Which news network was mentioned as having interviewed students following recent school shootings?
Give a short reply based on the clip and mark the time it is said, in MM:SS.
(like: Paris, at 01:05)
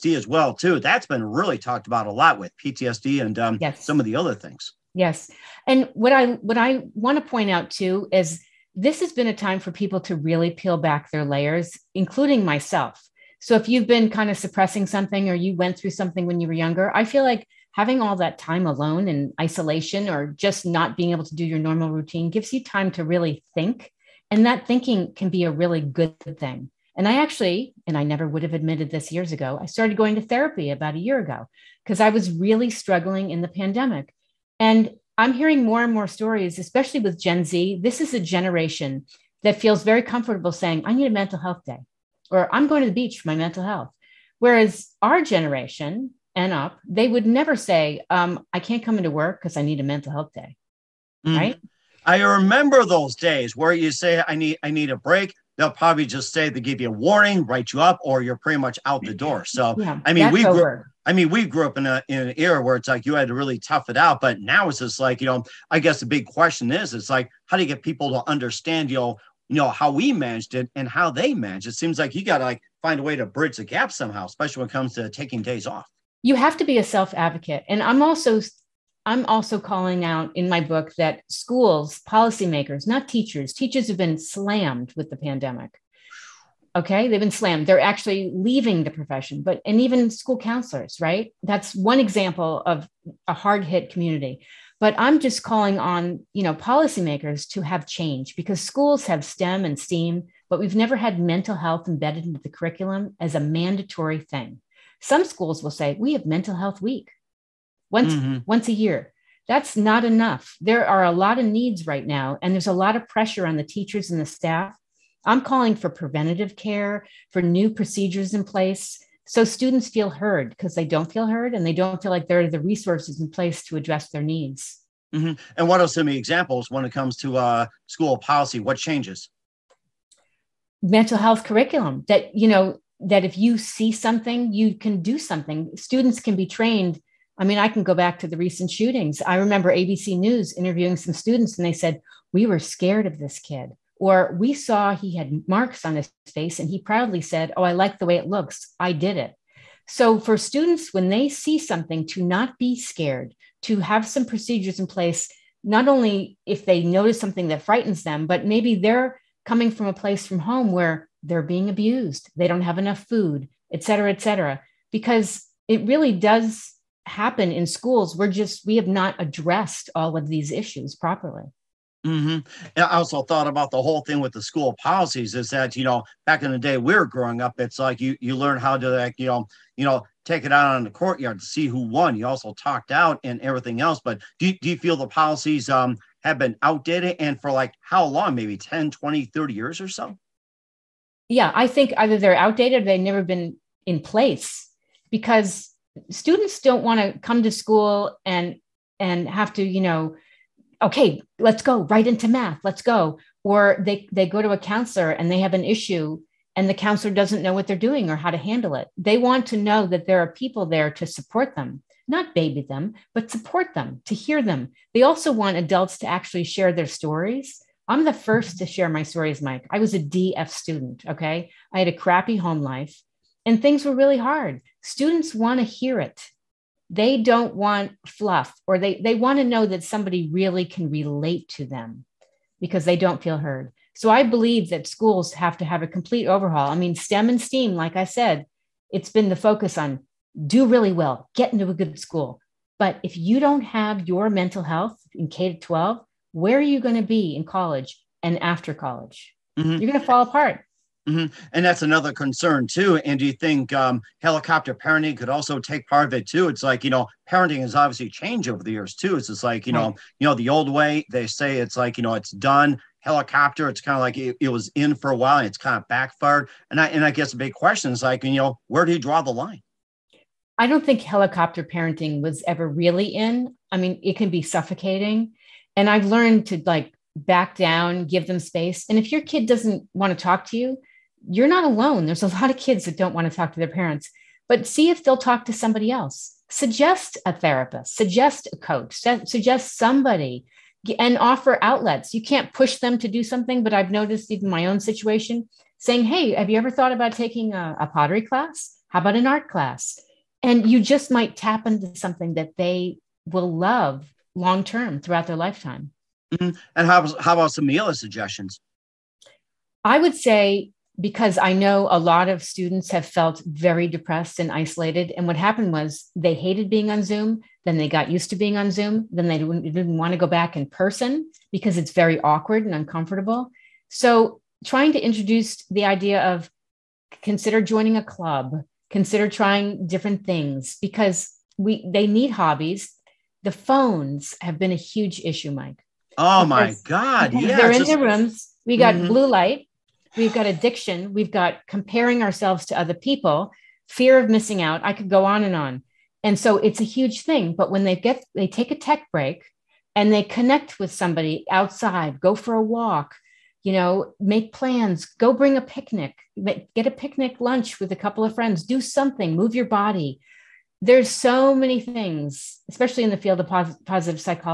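ABC News, at 02:19.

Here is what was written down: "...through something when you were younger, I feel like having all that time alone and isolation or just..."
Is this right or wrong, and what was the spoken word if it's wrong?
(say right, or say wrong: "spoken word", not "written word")
right.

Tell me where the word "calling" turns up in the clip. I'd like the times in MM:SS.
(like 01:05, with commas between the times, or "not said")
01:19, 01:35, 01:55.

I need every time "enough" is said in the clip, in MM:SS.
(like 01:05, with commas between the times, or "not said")
01:50, 02:42.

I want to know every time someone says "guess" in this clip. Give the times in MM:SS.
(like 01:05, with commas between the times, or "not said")
01:05, 04:27.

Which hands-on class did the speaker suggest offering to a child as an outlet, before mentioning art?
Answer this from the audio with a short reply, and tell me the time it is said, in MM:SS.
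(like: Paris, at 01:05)
Pottery class, at 04:57.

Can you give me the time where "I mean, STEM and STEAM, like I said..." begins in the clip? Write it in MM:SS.
03:56.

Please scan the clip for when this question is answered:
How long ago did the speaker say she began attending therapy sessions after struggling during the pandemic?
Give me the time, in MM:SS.
00:30.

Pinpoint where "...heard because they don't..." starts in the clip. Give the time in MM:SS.
02:00.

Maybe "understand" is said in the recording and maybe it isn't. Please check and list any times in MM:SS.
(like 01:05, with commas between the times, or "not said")
01:08.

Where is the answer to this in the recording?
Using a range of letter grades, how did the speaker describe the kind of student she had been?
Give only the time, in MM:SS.
03:39.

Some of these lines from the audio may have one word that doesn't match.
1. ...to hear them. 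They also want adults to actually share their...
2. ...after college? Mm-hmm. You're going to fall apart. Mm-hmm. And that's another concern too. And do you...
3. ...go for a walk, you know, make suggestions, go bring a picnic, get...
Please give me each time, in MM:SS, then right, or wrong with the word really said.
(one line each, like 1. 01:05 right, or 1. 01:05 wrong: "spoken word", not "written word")
1. 03:34 right
2. 04:08 right
3. 05:52 wrong: "plans", not "suggestions".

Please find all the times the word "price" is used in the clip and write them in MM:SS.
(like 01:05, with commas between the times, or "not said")
not said.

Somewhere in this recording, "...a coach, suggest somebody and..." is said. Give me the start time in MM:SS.
04:48.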